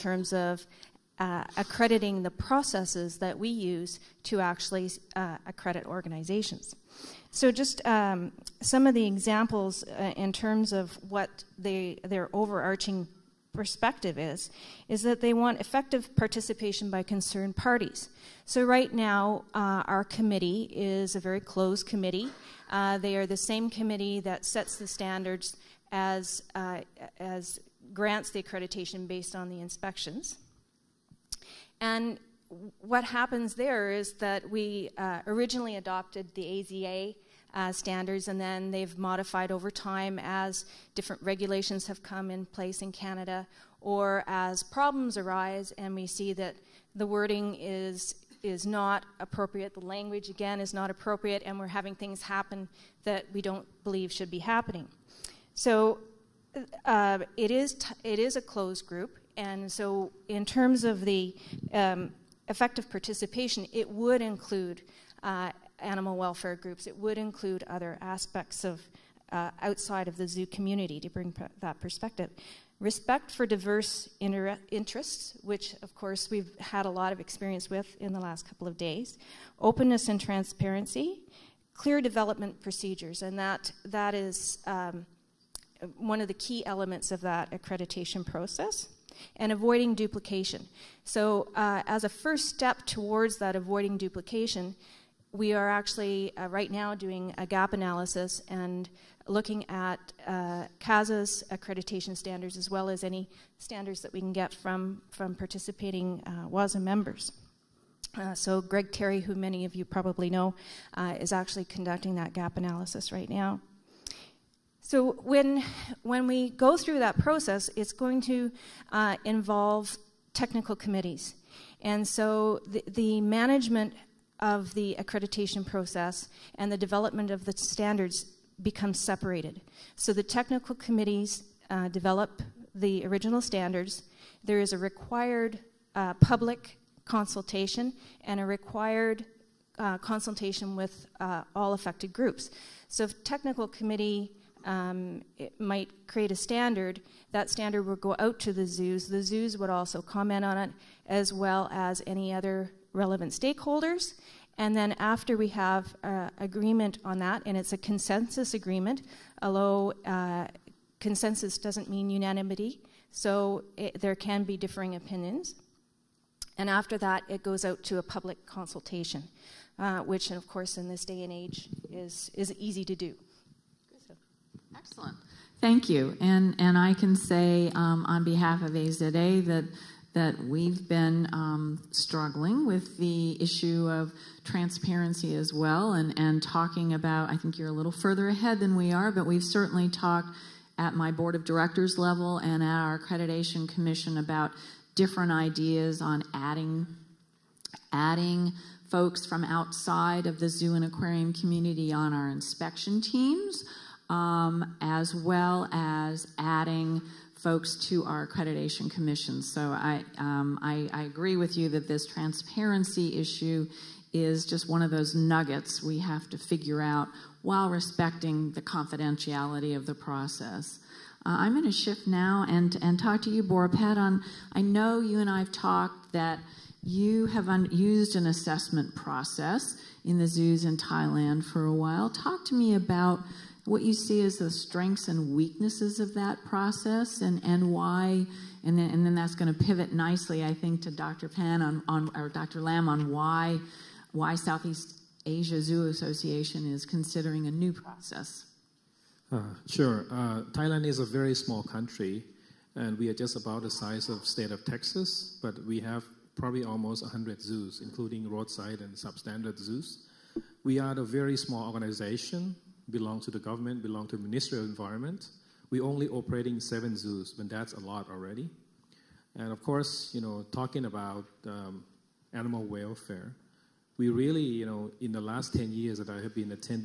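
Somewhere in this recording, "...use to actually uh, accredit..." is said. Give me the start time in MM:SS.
00:03.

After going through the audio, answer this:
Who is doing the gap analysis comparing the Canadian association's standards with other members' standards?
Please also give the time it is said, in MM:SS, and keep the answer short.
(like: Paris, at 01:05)
Greg Terry, at 01:48.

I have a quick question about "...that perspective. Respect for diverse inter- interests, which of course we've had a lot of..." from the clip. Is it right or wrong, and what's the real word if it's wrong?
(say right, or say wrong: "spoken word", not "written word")
right.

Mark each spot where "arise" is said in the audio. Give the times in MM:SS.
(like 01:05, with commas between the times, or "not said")
00:45.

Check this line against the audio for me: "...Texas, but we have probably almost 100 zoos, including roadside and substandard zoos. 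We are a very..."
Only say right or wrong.
right.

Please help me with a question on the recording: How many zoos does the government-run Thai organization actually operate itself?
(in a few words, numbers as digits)
7.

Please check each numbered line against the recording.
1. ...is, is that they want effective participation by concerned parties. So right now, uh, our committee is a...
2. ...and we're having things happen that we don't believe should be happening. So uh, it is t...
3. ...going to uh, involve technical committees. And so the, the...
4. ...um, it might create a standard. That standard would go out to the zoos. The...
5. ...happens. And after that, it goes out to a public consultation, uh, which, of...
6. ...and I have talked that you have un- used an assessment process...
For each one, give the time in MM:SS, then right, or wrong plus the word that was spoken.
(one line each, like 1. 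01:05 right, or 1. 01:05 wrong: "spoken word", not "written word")
1. 00:14 right
2. 00:51 right
3. 01:57 right
4. 02:24 right
5. 02:44 wrong: "opinions", not "happens"
6. 03:45 right.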